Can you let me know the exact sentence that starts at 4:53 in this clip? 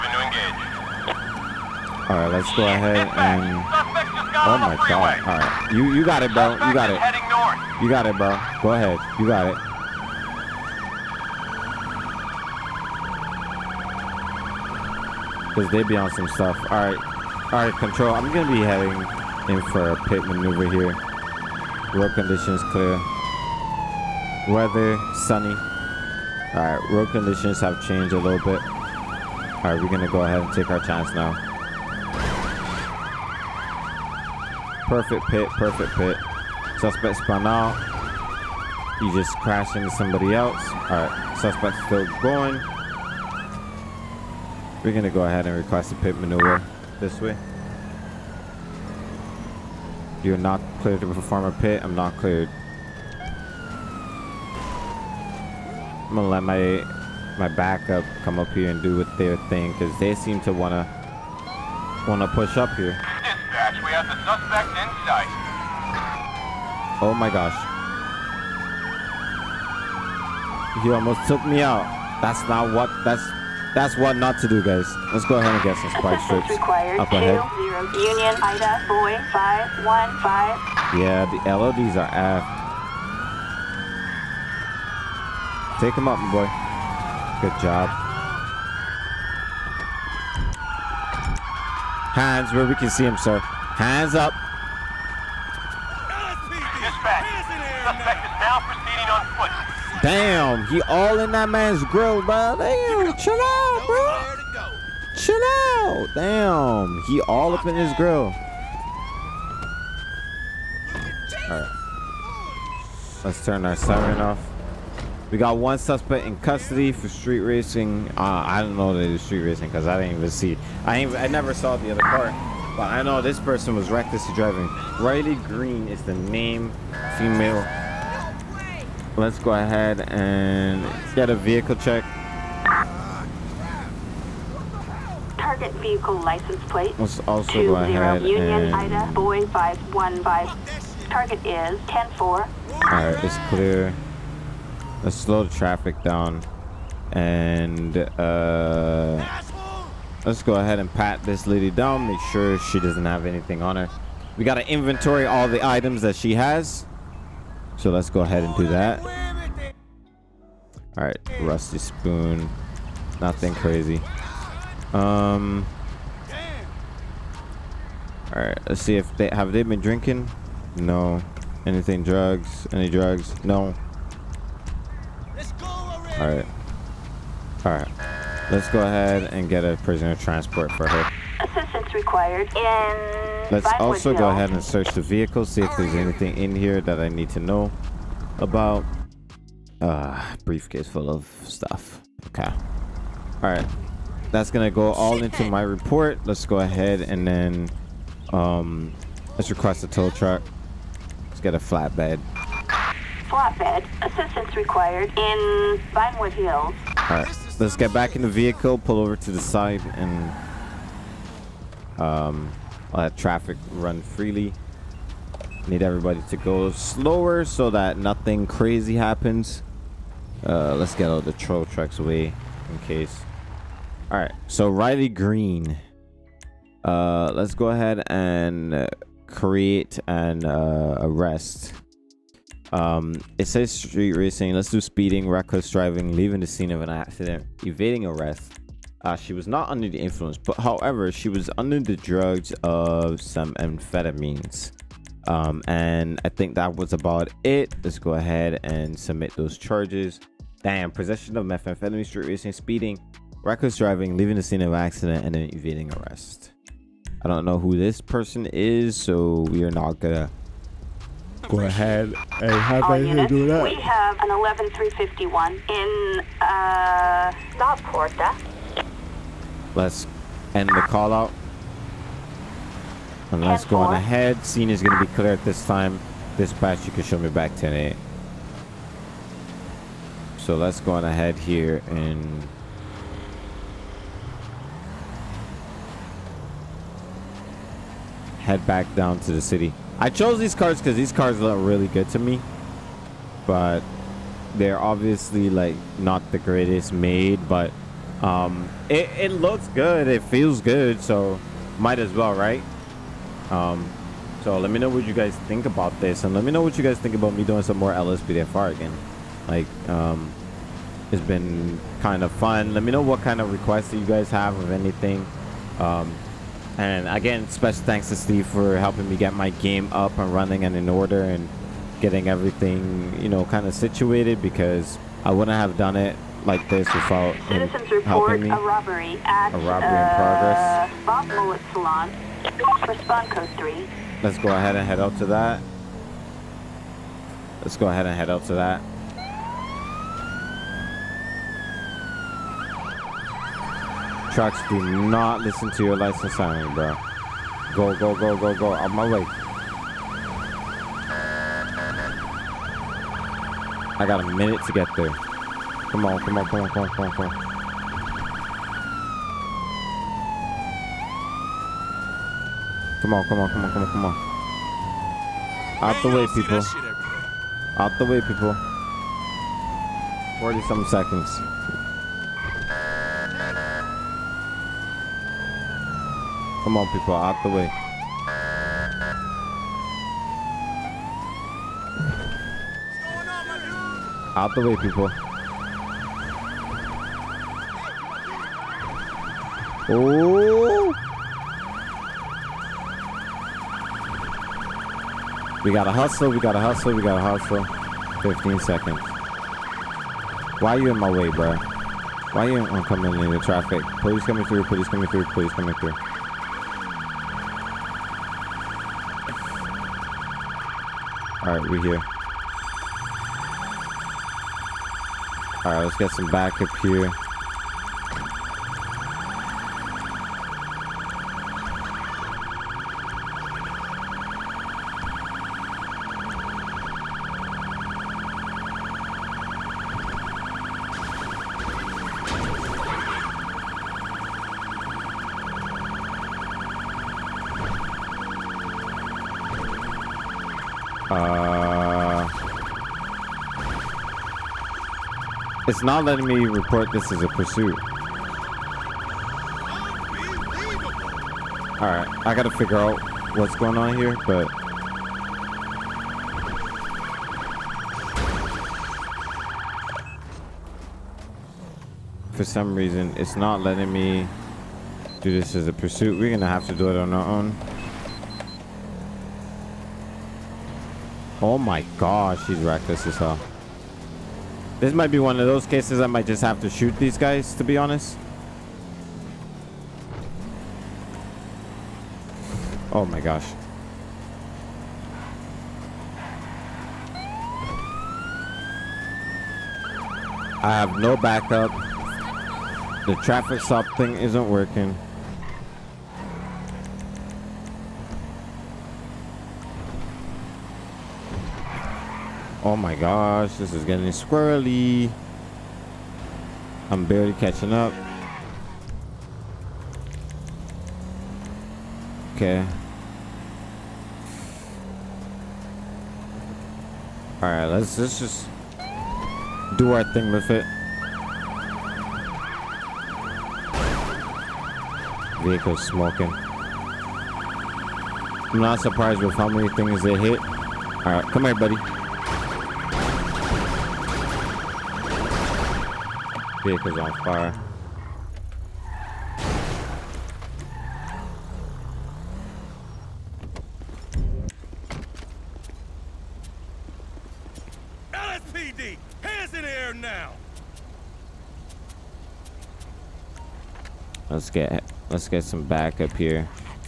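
But they're obviously like not the greatest made, but um, it, it looks good.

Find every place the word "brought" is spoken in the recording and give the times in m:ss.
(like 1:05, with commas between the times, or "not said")
not said.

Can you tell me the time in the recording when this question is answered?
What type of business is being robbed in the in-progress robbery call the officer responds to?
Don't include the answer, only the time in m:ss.
5:31.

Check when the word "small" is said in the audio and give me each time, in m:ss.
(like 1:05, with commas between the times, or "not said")
not said.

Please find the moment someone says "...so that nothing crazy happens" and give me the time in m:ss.
3:37.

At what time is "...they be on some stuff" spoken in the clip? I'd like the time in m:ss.
0:15.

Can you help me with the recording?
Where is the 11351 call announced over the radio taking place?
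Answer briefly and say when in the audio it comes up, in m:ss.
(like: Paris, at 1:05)
La Puerta, at 4:27.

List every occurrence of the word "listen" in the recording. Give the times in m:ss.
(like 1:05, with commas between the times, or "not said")
5:45.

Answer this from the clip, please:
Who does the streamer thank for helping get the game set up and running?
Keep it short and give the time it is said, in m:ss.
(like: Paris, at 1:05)
Steve, at 5:18.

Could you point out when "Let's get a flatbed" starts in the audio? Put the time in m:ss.
3:21.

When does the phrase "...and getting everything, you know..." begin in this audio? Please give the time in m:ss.
5:21.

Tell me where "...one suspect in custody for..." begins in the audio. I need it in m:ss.
1:55.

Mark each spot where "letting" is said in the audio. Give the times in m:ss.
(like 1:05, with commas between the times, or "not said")
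7:26, 7:43.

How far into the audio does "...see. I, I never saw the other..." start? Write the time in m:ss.
2:00.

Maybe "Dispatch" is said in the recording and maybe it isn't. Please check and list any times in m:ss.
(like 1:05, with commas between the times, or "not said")
4:36.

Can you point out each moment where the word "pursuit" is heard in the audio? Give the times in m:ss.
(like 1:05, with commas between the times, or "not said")
7:27, 7:45.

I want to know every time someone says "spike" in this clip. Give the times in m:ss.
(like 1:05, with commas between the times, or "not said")
1:15.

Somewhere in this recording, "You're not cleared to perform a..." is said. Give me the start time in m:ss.
0:50.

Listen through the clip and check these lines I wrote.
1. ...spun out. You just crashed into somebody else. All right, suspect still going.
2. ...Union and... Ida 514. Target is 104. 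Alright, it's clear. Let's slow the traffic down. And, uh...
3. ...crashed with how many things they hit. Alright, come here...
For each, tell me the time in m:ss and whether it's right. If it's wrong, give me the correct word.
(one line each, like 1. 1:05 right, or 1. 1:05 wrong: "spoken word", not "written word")
1. 0:37 right
2. 2:18 wrong: "515", not "514"
3. 8:48 wrong: "surprised", not "crashed".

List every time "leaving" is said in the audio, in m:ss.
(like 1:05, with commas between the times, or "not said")
3:56, 4:14.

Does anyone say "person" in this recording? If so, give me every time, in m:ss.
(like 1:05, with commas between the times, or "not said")
2:03, 4:18.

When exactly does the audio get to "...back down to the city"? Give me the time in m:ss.
4:48.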